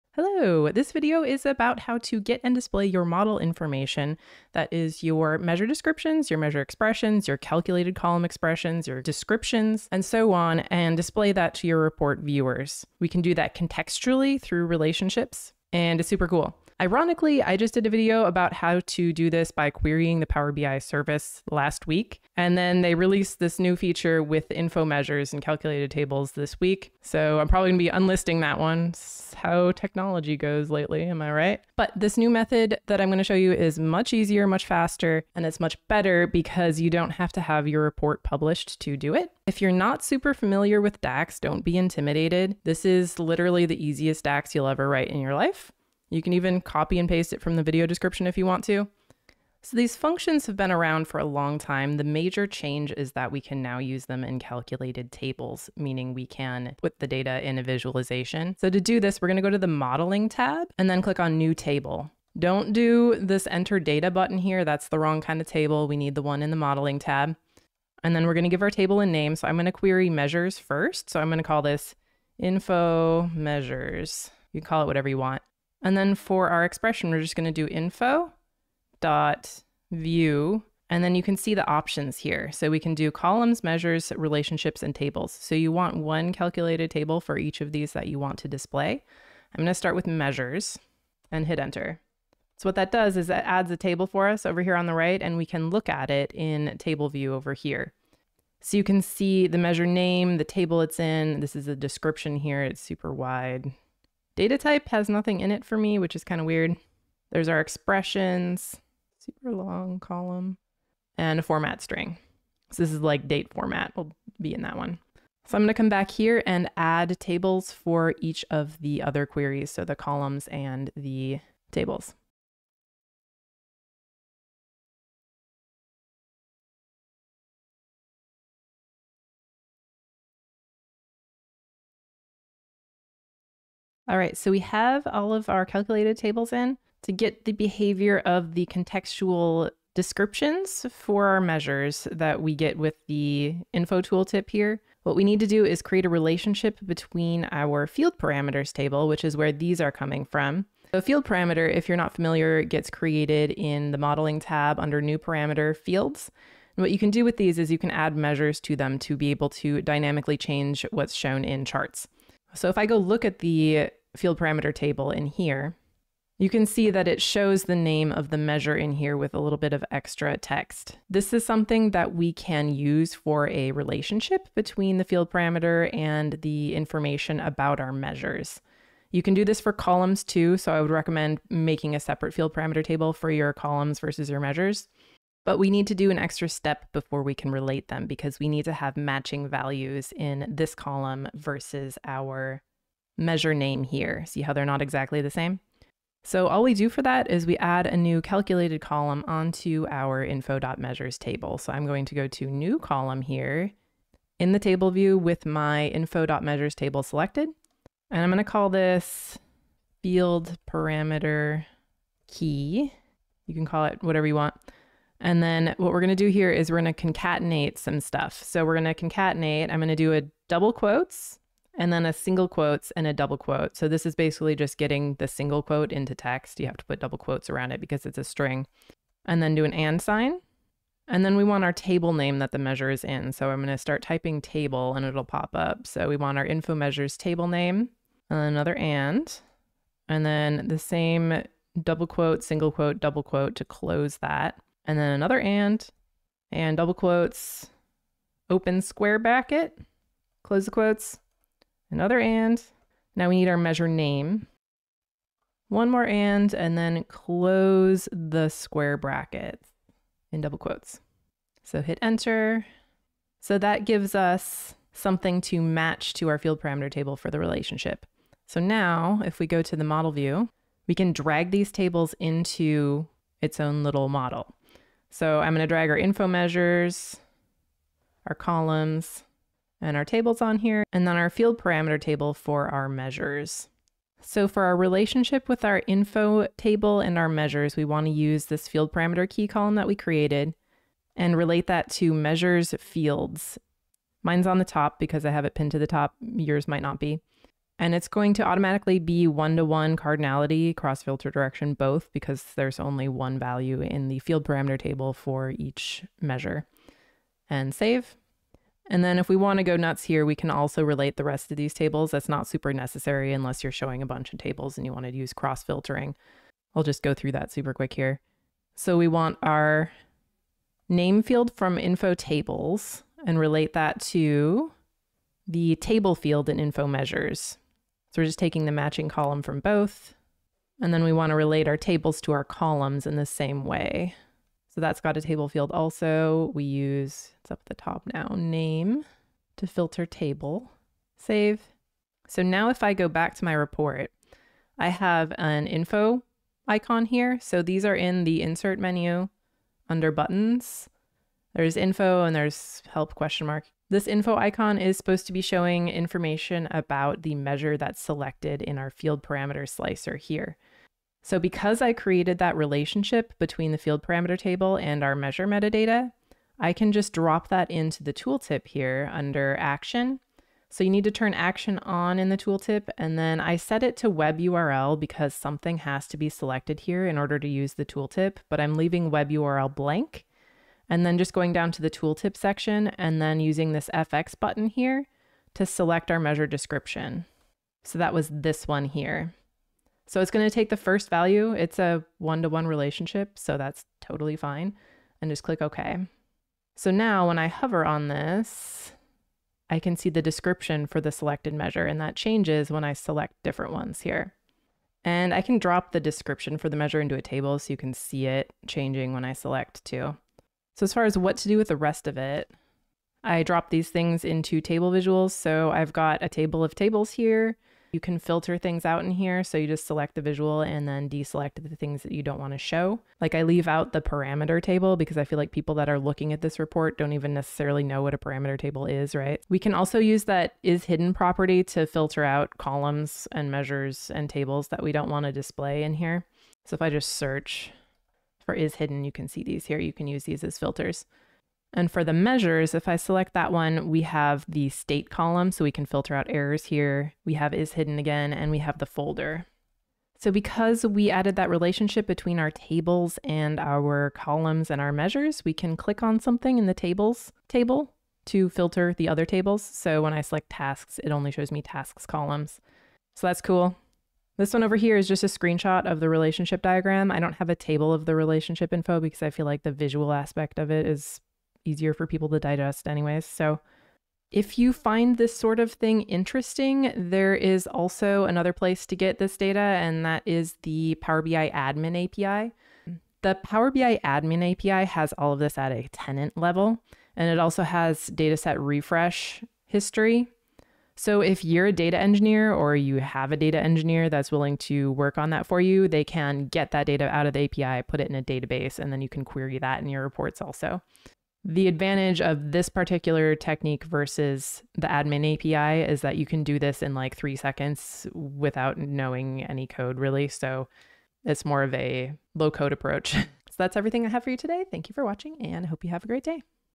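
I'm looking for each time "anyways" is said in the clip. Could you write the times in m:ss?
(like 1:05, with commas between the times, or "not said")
7:52.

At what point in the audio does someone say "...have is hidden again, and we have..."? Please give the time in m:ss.
7:27.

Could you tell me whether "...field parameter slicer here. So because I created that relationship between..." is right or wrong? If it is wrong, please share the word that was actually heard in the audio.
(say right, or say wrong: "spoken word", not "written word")
right.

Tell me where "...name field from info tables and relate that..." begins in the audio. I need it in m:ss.
5:20.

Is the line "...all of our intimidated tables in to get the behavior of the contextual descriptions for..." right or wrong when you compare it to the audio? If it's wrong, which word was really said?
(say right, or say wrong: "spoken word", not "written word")
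wrong: "calculated", not "intimidated".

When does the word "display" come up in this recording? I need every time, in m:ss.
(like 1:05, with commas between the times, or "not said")
0:02, 0:10, 1:28, 7:15.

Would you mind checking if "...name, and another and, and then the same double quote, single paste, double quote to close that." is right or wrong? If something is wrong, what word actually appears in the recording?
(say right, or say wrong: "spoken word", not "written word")
wrong: "quote", not "paste".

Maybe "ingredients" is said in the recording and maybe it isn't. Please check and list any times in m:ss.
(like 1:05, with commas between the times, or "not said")
not said.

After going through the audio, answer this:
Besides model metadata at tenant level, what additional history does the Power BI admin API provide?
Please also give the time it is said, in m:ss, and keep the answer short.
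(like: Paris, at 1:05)
Dataset refresh history, at 8:08.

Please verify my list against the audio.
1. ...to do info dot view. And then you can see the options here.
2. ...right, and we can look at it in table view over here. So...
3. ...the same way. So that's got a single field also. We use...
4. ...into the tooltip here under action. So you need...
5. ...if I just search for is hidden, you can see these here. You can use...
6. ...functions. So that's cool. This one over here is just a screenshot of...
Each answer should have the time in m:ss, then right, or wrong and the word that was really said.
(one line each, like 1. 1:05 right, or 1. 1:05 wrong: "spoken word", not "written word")
1. 1:17 right
2. 1:34 right
3. 5:33 wrong: "table", not "single"
4. 6:07 right
5. 7:16 right
6. 7:42 wrong: "columns", not "functions".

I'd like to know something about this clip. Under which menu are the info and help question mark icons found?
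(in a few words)
Insert menu.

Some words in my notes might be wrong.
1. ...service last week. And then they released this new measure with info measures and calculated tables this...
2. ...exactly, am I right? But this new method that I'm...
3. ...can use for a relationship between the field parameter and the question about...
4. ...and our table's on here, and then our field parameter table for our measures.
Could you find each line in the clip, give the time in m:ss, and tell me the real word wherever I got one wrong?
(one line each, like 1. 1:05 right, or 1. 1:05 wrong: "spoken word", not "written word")
1. 0:20 wrong: "feature", not "measure"
2. 0:30 wrong: "lately", not "exactly"
3. 2:52 wrong: "information", not "question"
4. 4:39 right.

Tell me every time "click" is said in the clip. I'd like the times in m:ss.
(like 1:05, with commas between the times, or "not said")
1:01, 6:35, 7:35.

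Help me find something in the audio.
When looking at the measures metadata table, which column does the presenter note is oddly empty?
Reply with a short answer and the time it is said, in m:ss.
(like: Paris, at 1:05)
Data type, at 1:44.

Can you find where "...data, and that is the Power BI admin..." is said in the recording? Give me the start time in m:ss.
7:59.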